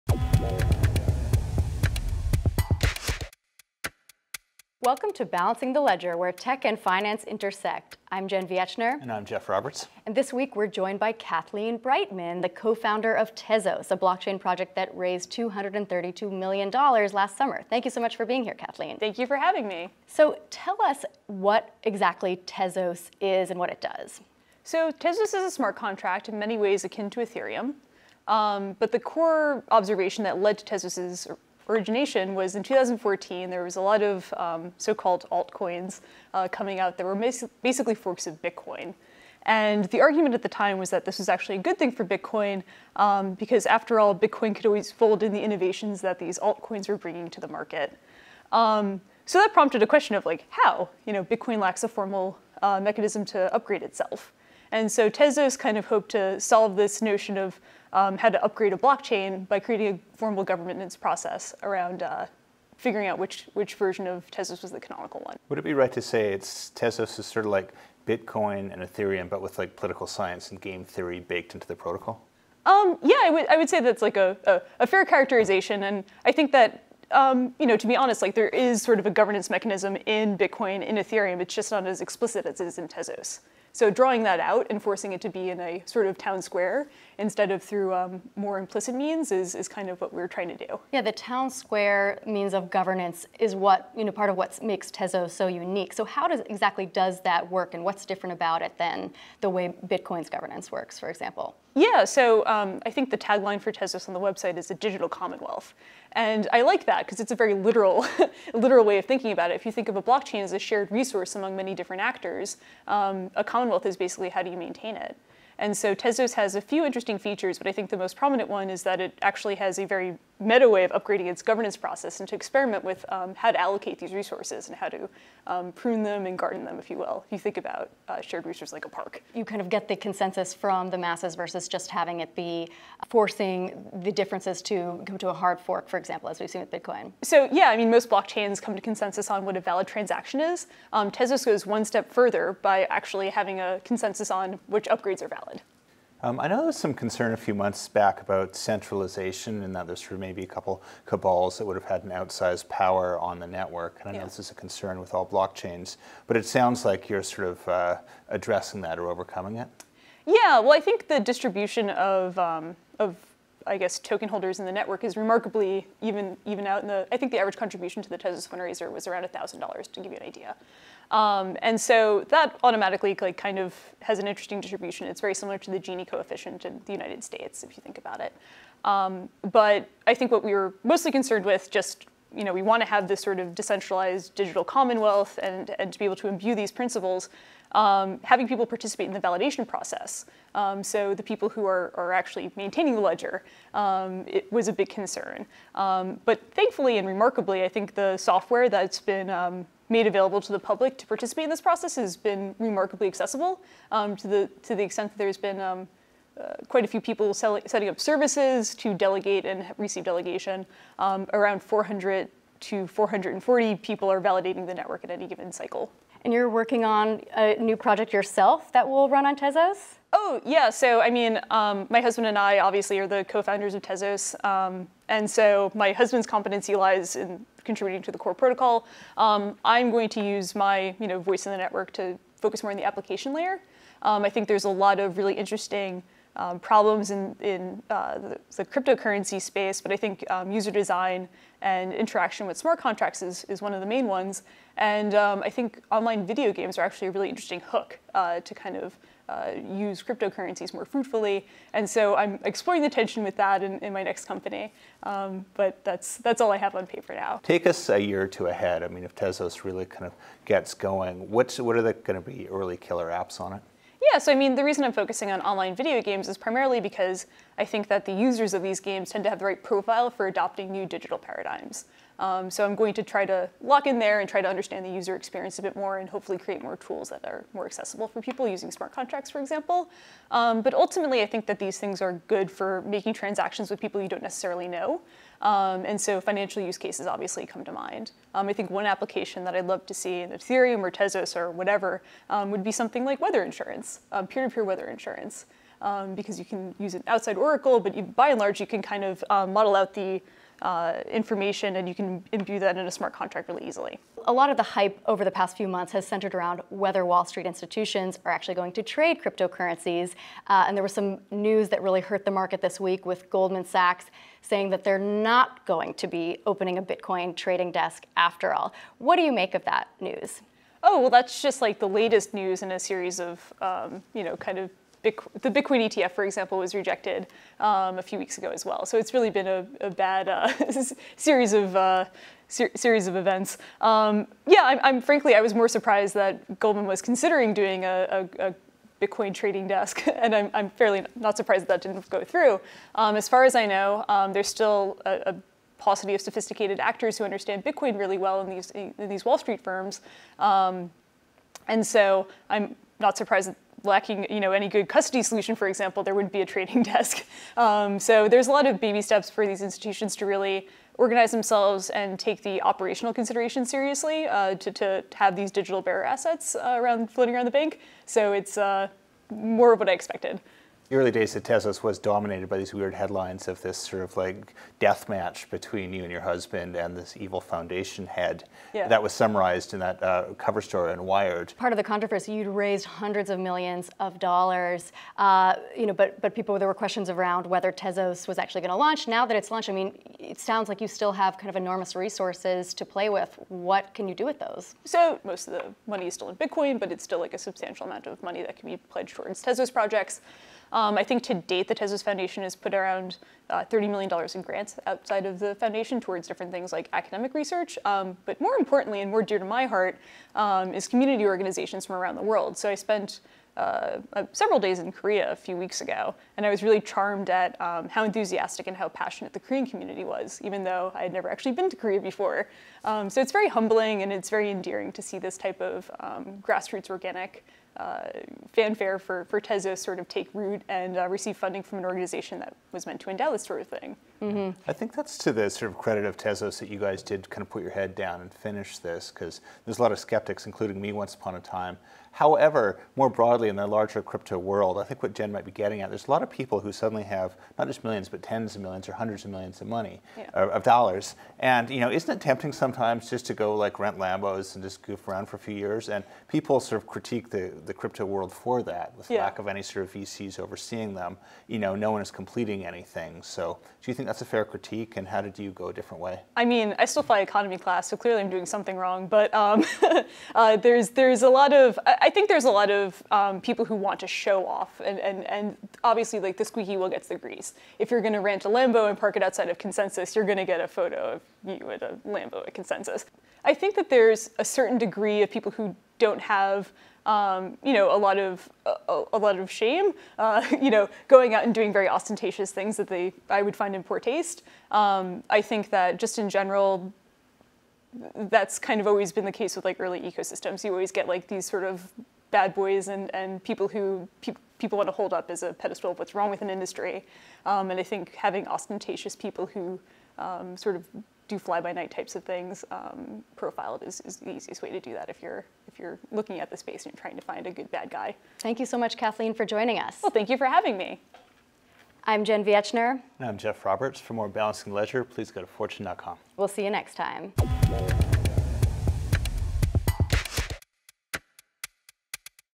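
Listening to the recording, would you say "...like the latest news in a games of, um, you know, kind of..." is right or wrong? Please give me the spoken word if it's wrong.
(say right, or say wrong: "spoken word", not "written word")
wrong: "series", not "games".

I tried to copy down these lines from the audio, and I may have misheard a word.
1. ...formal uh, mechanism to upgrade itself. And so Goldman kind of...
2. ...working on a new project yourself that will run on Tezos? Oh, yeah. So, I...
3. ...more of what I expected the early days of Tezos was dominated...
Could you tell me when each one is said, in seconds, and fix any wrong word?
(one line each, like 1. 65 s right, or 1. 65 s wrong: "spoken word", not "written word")
1. 51 s wrong: "Tezos", not "Goldman"
2. 216 s right
3. 369 s right.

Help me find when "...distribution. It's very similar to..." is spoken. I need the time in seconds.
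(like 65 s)
174 s.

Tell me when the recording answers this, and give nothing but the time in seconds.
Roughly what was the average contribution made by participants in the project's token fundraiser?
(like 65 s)
169 s.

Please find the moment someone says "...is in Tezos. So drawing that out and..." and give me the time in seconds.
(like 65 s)
82 s.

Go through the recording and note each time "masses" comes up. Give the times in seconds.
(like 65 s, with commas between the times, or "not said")
130 s.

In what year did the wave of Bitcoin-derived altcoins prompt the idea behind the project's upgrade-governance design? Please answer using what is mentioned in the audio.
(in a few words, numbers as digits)
2014.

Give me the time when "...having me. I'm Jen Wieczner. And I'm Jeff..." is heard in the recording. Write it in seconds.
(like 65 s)
520 s.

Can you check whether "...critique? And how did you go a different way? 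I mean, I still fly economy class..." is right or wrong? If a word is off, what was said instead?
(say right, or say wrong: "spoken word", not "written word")
right.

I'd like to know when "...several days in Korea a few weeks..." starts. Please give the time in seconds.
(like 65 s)
414 s.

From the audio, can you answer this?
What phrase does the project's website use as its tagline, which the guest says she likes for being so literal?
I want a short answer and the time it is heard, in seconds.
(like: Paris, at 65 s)
a digital commonwealth, at 104 s.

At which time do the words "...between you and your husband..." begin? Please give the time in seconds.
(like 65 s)
375 s.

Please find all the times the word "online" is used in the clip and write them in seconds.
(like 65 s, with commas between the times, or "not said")
245 s, 265 s.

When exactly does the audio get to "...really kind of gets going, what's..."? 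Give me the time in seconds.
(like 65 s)
259 s.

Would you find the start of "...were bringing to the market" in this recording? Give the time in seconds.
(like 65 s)
46 s.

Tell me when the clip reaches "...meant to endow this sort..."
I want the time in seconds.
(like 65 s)
432 s.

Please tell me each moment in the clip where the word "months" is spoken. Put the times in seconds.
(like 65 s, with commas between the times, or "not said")
147 s, 305 s.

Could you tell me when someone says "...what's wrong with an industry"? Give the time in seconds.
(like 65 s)
505 s.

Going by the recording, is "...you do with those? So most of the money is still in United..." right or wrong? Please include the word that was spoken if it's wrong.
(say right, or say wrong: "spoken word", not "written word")
wrong: "Bitcoin", not "United".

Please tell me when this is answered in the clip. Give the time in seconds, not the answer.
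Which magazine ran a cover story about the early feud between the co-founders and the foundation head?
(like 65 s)
381 s.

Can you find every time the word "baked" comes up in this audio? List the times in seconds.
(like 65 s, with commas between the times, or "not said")
71 s.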